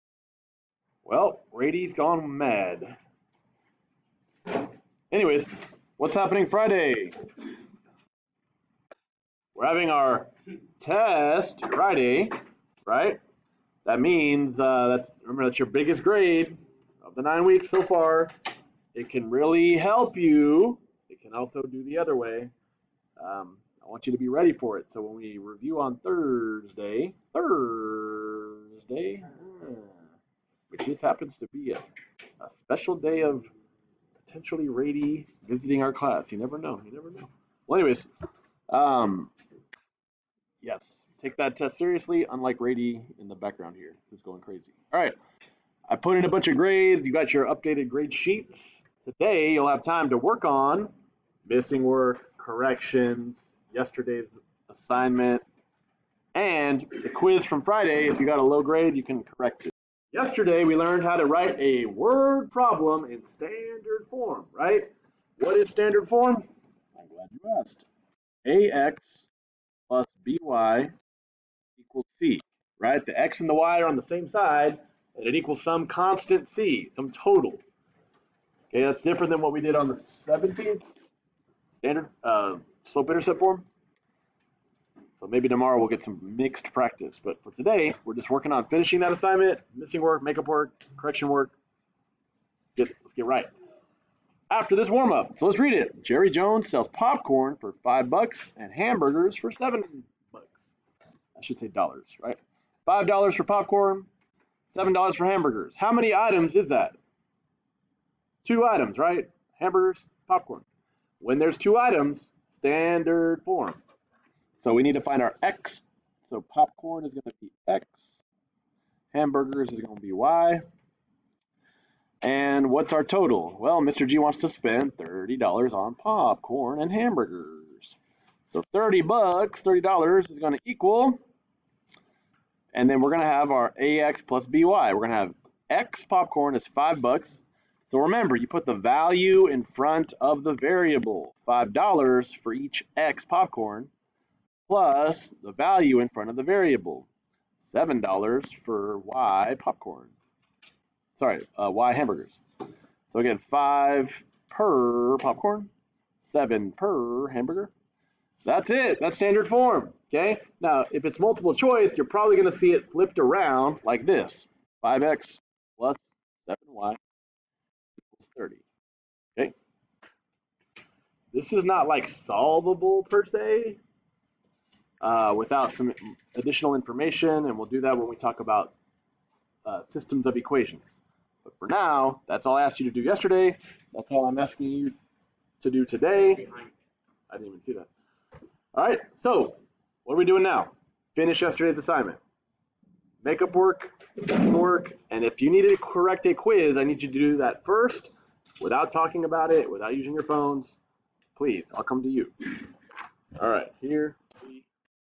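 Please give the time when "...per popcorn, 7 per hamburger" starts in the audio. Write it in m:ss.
2:34.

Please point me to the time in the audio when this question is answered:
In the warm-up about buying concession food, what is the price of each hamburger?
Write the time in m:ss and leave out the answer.
1:44.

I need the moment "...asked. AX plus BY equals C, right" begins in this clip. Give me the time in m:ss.
1:07.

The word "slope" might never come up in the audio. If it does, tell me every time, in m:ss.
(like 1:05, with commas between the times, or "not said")
1:22.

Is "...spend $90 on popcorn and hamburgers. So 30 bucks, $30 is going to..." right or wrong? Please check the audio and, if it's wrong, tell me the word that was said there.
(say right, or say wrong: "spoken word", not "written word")
wrong: "30", not "90".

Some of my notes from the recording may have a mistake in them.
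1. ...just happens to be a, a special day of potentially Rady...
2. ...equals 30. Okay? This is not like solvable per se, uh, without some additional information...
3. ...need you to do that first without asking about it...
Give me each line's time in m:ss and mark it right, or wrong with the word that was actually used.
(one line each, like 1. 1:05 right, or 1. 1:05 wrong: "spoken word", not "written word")
1. 0:30 right
2. 2:46 right
3. 3:16 wrong: "talking", not "asking".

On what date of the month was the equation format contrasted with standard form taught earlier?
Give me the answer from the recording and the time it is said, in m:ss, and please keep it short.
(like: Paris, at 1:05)
17th, at 1:20.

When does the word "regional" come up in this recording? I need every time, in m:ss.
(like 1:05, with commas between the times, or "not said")
not said.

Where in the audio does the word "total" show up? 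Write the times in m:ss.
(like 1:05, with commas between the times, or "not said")
1:17, 2:03.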